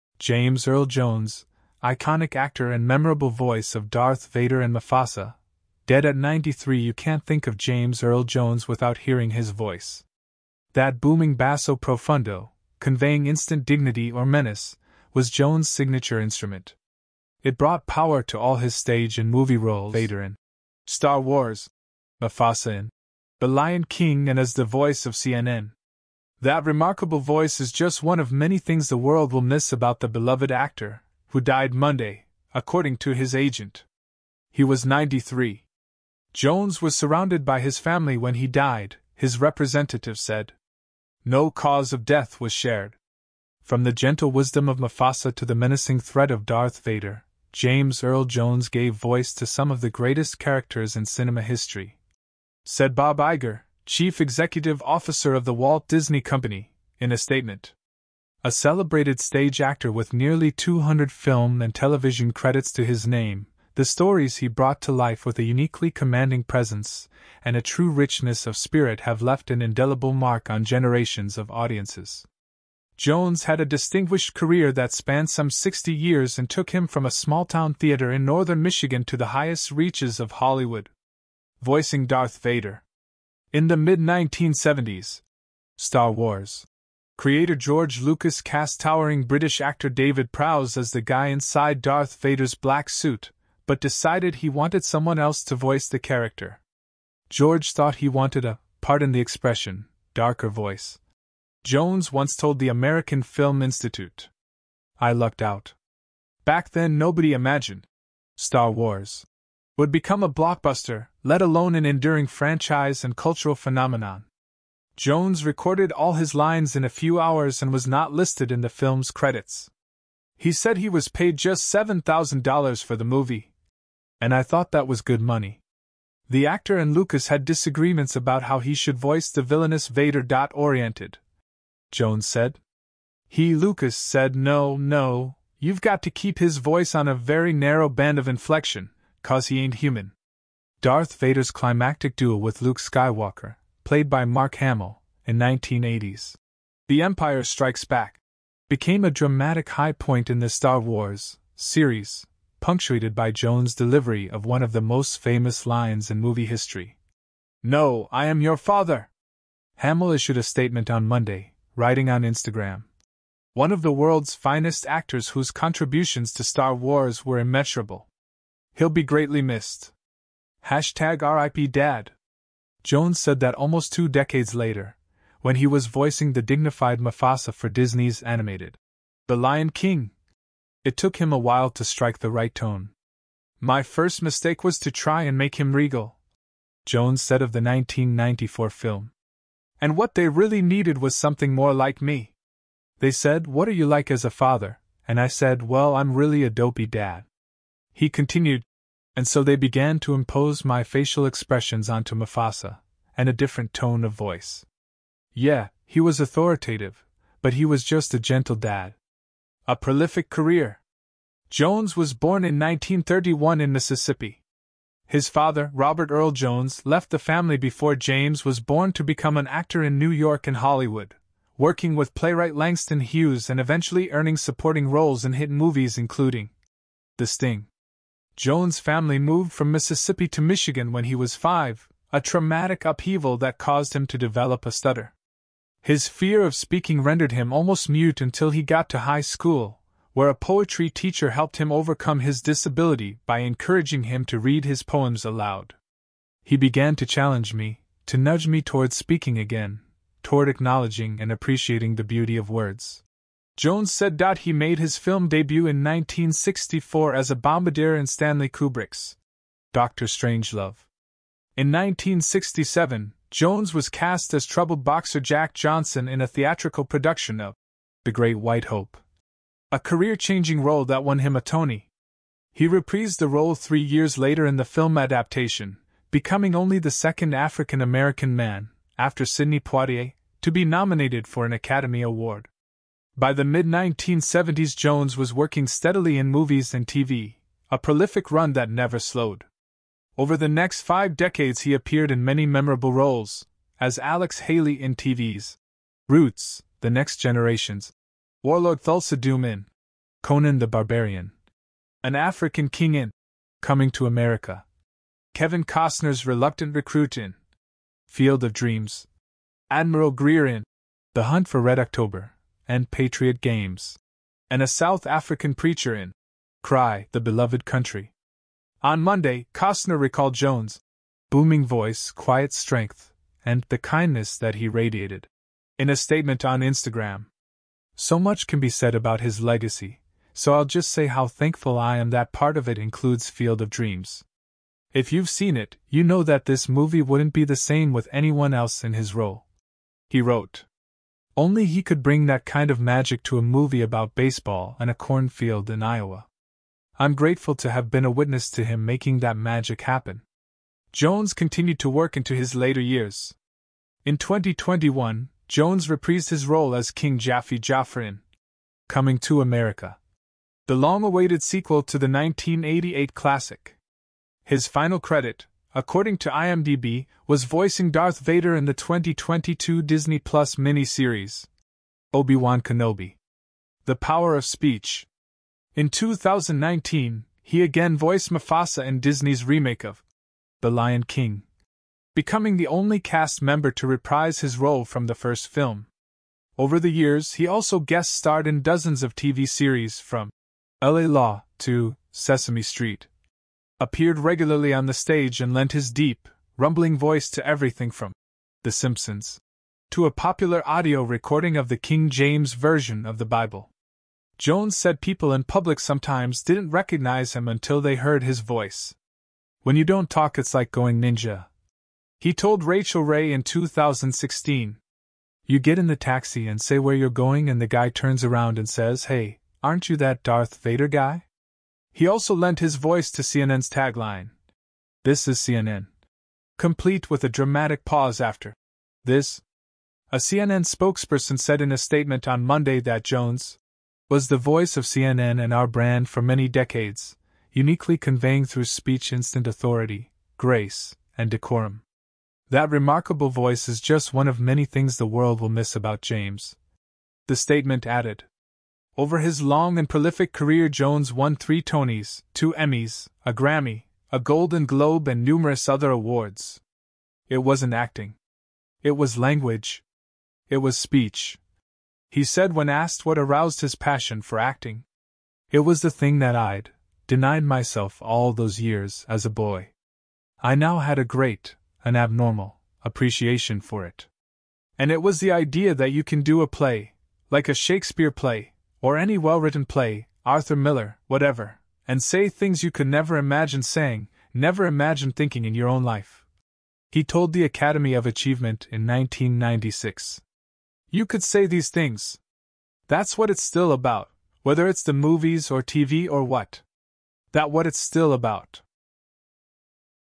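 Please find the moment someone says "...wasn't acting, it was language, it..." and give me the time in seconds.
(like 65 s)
457 s.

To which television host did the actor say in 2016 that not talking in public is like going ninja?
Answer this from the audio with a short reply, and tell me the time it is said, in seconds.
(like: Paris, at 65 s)
Rachael Ray, at 412 s.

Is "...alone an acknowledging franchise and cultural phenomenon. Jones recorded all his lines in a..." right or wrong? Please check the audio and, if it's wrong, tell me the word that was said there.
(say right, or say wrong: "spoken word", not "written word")
wrong: "enduring", not "acknowledging".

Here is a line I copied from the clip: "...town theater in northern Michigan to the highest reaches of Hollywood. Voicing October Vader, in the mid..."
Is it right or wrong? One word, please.
wrong.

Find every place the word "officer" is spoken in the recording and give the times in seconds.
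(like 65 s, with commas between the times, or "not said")
54 s.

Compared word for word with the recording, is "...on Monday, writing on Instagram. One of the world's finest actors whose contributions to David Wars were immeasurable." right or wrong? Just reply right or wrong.
wrong.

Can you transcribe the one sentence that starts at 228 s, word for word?
Jones' family moved from Mississippi to Michigan when he was five, a traumatic upheaval that caused him to develop a stutter.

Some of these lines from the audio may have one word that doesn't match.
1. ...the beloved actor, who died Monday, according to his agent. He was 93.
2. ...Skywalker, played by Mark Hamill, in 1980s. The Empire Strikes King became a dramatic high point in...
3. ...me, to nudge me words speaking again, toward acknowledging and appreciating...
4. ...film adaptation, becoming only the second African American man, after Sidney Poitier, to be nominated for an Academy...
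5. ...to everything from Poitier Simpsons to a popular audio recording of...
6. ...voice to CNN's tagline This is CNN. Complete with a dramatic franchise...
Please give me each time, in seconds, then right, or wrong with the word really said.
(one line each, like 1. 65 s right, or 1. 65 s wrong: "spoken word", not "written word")
1. 29 s right
2. 142 s wrong: "Back", not "King"
3. 247 s wrong: "towards", not "words"
4. 274 s right
5. 397 s wrong: "The", not "Poitier"
6. 422 s wrong: "pause", not "franchise".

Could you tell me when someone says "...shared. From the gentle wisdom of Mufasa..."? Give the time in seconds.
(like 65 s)
42 s.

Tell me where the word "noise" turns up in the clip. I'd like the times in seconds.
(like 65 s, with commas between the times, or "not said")
not said.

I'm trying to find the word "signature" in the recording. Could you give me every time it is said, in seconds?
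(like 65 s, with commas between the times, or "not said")
15 s.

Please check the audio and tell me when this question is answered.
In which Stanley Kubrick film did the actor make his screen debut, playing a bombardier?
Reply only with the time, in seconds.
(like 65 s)
259 s.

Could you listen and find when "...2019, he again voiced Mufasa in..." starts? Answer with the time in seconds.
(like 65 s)
375 s.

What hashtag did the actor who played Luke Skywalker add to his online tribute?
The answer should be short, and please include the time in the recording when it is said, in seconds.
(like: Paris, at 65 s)
RIP Dad, at 171 s.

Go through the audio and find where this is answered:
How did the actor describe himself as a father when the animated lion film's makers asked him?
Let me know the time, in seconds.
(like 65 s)
196 s.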